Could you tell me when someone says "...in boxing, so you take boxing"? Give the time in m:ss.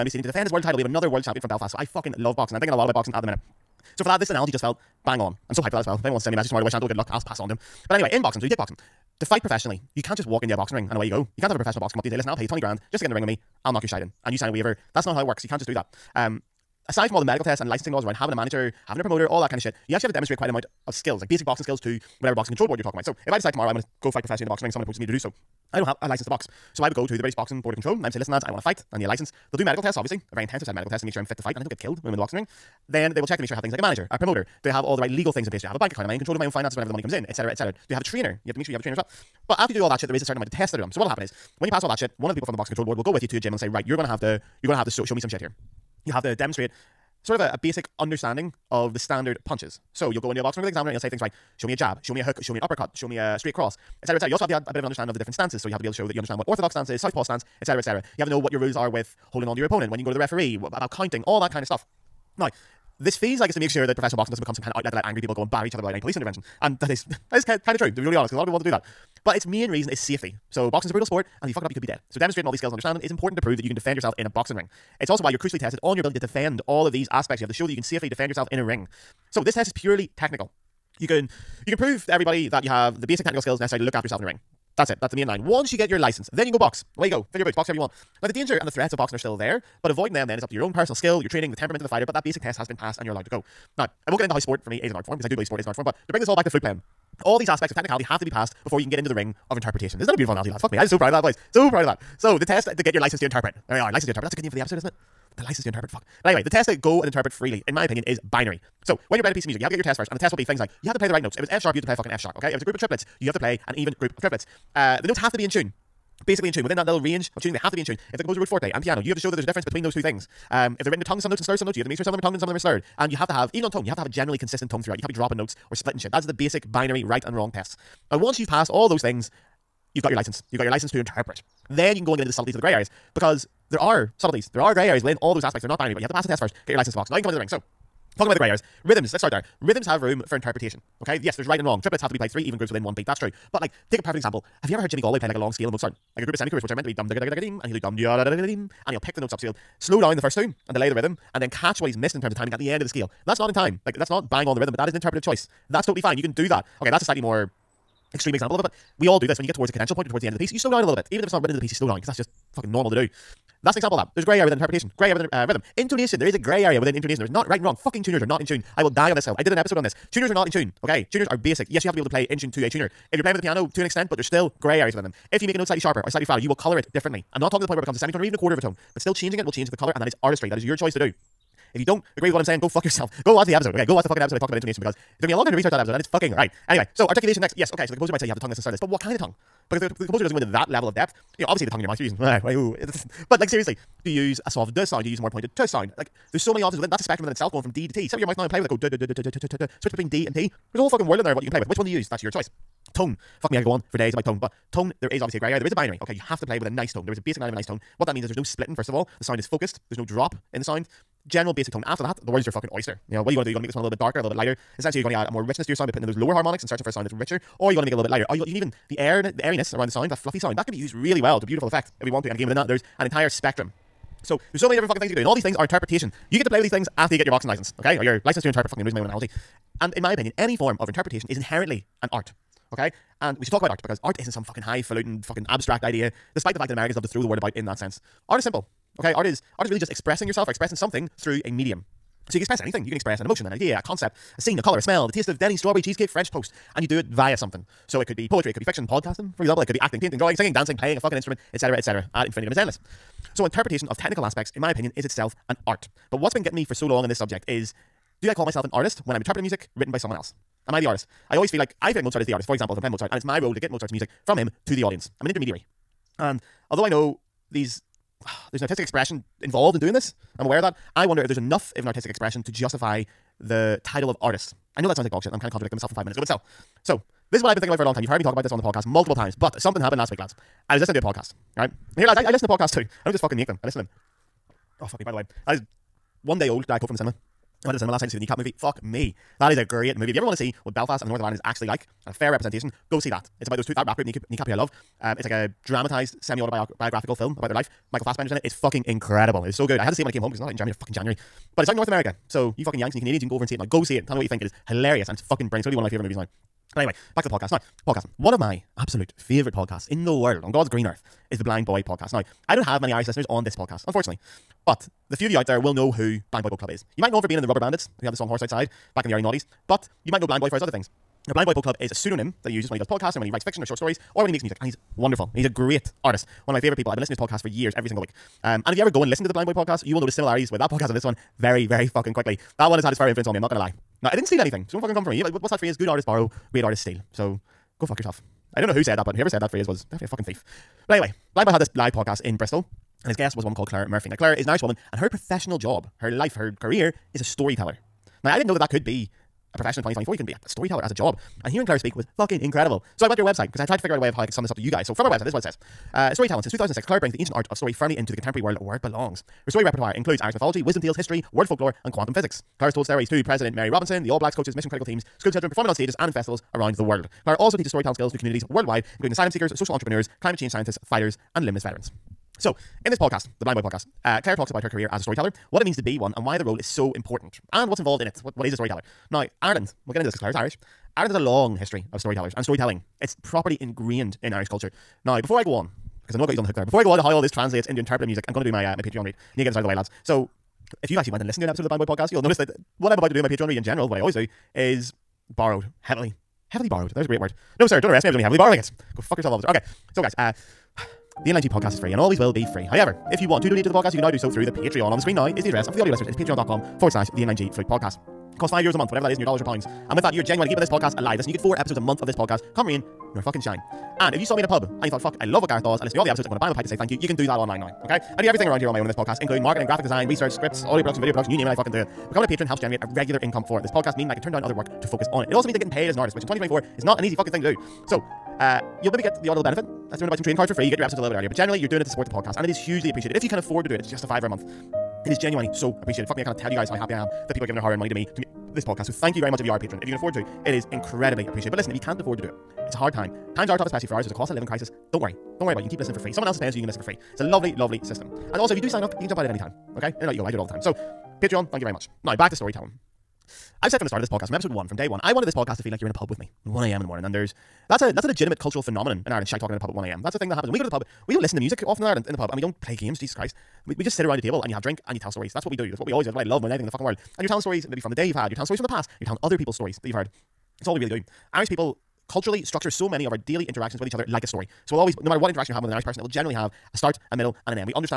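0:08.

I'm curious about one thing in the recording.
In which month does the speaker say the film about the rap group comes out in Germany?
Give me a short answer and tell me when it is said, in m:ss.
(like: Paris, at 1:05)
January, at 5:00.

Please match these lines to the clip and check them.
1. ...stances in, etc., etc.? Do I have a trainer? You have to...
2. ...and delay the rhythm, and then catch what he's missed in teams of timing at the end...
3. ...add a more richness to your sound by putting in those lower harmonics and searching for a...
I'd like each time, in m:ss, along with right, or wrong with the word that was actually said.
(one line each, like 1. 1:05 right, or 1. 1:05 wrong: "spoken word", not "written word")
1. 0:37 wrong: "comes", not "stances"
2. 2:30 wrong: "terms", not "teams"
3. 3:35 right.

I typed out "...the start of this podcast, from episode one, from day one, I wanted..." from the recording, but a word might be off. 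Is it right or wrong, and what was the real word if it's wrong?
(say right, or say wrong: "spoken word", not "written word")
right.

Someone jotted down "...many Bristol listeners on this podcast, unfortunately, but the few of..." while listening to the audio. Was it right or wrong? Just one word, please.
wrong.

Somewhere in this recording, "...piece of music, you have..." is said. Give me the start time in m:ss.
1:49.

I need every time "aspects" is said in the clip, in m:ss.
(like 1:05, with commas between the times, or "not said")
1:17, 1:37, 2:15, 4:14.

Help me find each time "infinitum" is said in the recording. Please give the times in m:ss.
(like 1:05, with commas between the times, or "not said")
4:12.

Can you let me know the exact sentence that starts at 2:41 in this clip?
Even if it's not written into the piece, you slow down because that's just fucking normal to do.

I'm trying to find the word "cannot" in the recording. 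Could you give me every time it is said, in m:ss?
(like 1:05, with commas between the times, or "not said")
7:16.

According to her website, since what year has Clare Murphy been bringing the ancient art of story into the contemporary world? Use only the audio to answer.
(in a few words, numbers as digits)
2006.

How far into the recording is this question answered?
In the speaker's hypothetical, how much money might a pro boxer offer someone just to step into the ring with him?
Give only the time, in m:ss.
0:12.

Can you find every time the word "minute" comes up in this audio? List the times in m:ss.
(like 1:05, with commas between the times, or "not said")
0:03, 4:36.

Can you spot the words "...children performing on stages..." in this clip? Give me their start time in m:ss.
6:05.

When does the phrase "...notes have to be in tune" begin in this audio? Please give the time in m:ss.
1:55.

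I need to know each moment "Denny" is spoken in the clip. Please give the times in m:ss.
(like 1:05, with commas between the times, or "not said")
4:05.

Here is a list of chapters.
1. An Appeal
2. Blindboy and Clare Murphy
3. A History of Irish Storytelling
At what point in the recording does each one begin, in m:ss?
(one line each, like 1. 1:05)
1. 6:39
2. 4:15
3. 7:31.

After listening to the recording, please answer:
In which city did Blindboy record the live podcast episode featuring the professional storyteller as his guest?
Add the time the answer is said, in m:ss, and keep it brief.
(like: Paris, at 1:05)
Bristol, at 5:42.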